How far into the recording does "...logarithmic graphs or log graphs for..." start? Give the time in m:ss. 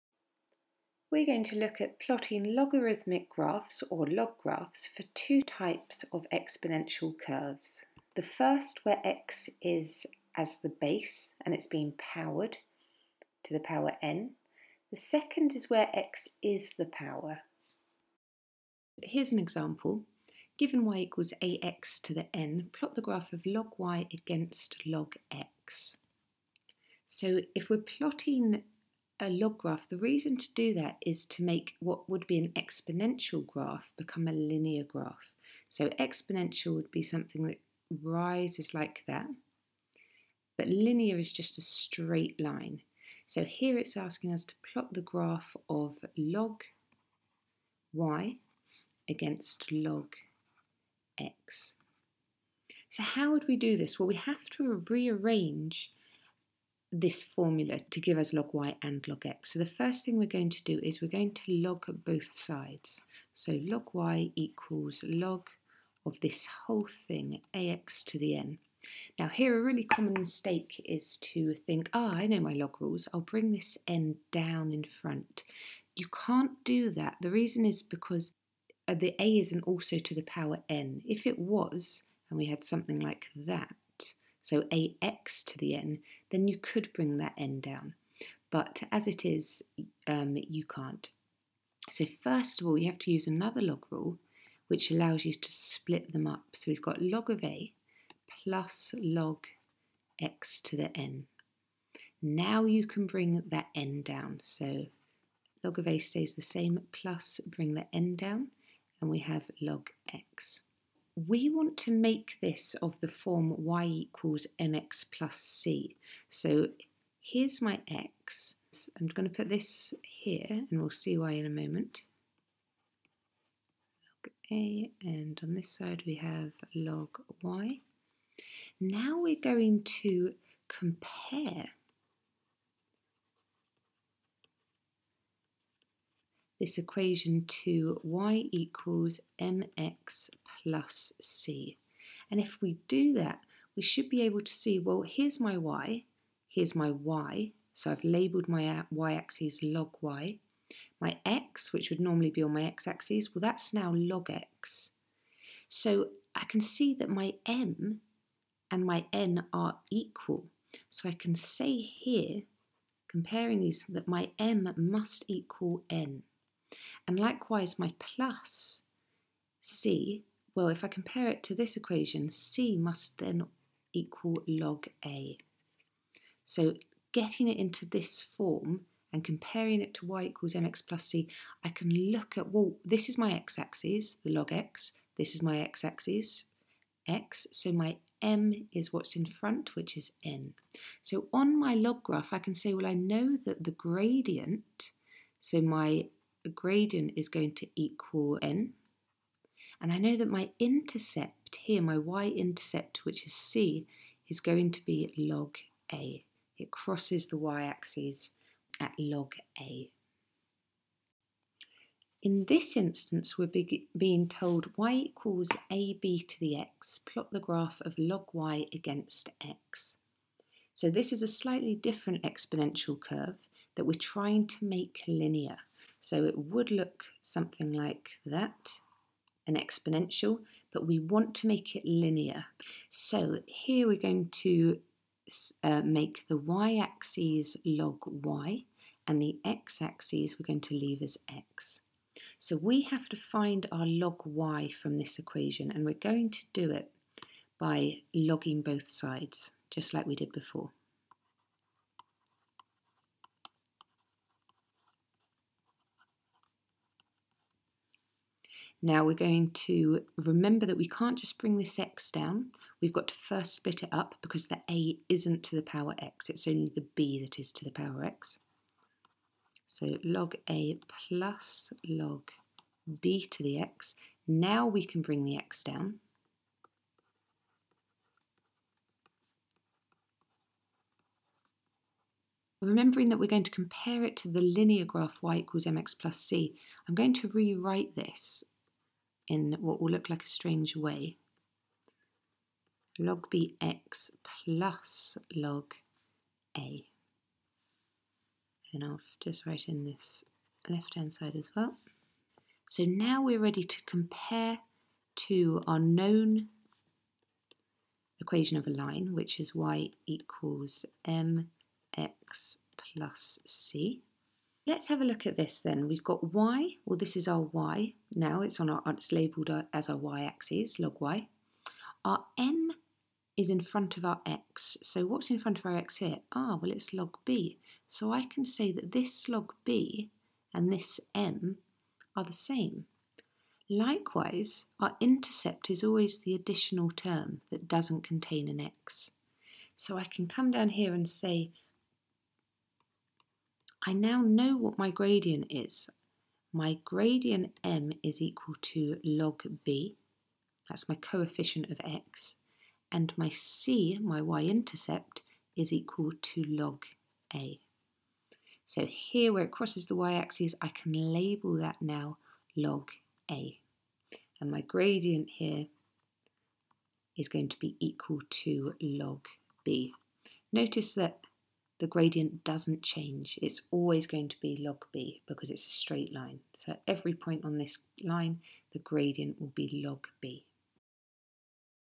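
0:02.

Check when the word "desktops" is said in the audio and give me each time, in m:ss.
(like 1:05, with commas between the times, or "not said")
not said.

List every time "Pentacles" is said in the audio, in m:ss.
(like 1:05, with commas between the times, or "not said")
not said.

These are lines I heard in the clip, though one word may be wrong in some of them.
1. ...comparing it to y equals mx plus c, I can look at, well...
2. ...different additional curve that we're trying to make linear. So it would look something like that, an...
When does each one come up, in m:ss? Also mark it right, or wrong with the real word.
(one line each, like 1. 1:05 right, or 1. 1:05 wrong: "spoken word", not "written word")
1. 2:59 right
2. 3:41 wrong: "exponential", not "additional".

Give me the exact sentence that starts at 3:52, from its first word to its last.
So here we're going to uh, make the y-axis log y, and the x-axis we're going to leave as x.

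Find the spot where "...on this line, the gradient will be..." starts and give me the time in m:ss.
6:17.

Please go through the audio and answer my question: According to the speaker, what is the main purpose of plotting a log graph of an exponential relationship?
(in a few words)
to make it linear.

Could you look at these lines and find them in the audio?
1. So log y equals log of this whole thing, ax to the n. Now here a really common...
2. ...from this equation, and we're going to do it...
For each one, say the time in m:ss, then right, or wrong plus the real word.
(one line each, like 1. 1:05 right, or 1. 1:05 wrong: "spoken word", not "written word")
1. 1:03 right
2. 4:04 right.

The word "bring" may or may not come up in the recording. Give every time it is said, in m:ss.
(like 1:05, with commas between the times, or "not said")
1:13, 1:26, 1:43, 1:47, 4:21, 4:35.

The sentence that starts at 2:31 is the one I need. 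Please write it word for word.
My x, which would normally be on my x-axis, well, that's now log x.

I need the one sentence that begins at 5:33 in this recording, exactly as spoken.
Likewise, our intercept is always the additional term that doesn't contain an x.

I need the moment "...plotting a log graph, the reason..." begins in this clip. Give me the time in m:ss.
0:27.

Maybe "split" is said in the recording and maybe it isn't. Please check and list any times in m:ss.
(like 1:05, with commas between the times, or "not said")
1:35, 4:23.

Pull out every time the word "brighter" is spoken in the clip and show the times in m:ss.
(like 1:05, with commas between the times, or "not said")
not said.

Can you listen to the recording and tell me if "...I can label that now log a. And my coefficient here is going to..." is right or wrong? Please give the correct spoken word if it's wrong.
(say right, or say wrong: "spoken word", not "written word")
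wrong: "gradient", not "coefficient".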